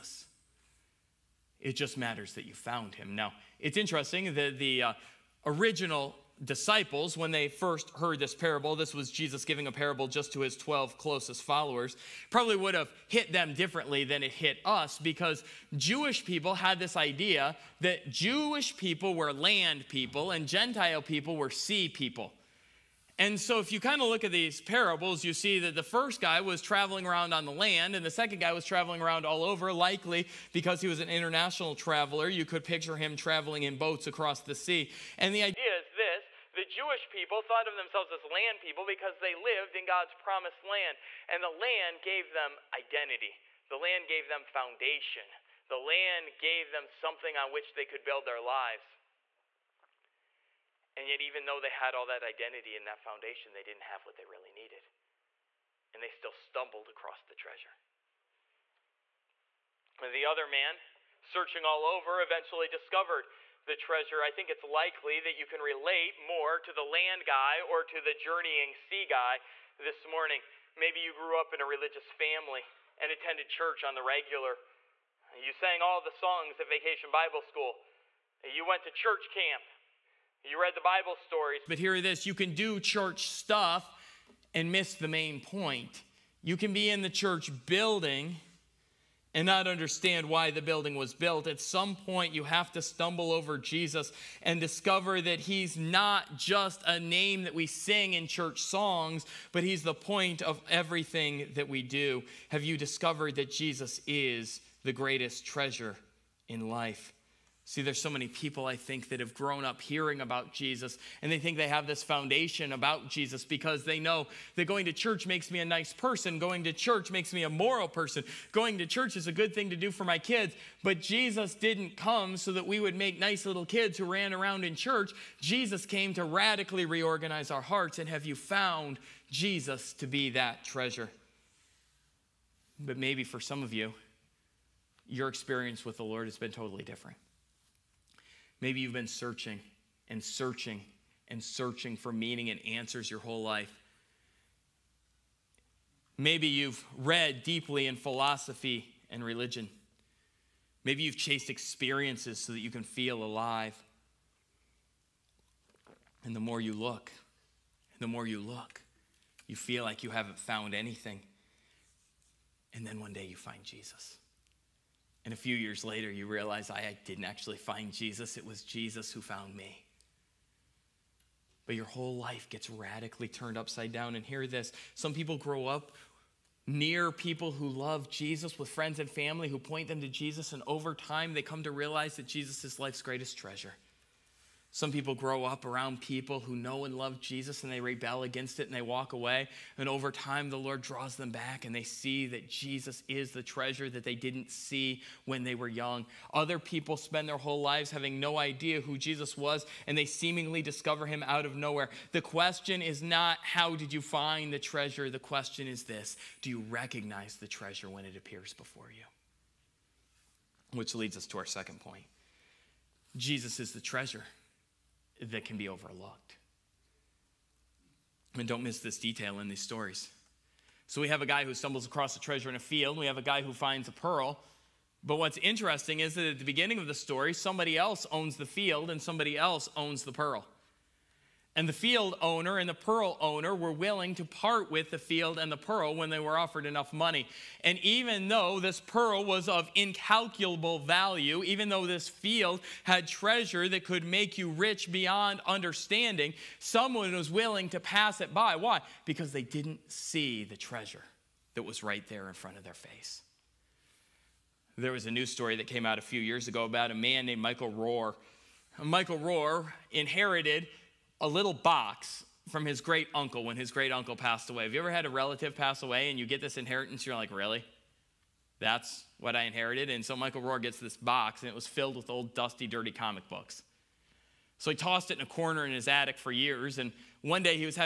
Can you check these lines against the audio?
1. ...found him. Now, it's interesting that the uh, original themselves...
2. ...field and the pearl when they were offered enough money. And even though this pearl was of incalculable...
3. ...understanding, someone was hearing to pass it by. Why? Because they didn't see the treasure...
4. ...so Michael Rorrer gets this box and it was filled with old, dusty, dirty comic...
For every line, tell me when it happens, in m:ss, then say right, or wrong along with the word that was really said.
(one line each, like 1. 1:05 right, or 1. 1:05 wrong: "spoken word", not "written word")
1. 0:02 wrong: "disciples", not "themselves"
2. 3:54 right
3. 4:05 wrong: "willing", not "hearing"
4. 4:30 right.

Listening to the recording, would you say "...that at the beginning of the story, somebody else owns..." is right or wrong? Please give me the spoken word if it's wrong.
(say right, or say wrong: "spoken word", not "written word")
right.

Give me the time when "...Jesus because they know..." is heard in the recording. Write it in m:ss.
1:53.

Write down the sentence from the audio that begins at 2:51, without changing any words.
But your whole life gets radically turned upside down.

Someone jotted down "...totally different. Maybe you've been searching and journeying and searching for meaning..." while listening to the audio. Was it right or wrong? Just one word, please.
wrong.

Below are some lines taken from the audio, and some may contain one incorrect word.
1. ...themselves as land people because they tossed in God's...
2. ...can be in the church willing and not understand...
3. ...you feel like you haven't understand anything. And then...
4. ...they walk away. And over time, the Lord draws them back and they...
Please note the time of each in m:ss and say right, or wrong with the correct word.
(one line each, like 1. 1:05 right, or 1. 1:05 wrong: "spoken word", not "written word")
1. 0:37 wrong: "lived", not "tossed"
2. 1:26 wrong: "building", not "willing"
3. 2:39 wrong: "found", not "understand"
4. 3:08 right.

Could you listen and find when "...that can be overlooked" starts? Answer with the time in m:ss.
3:35.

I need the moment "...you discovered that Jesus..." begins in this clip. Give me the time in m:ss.
1:42.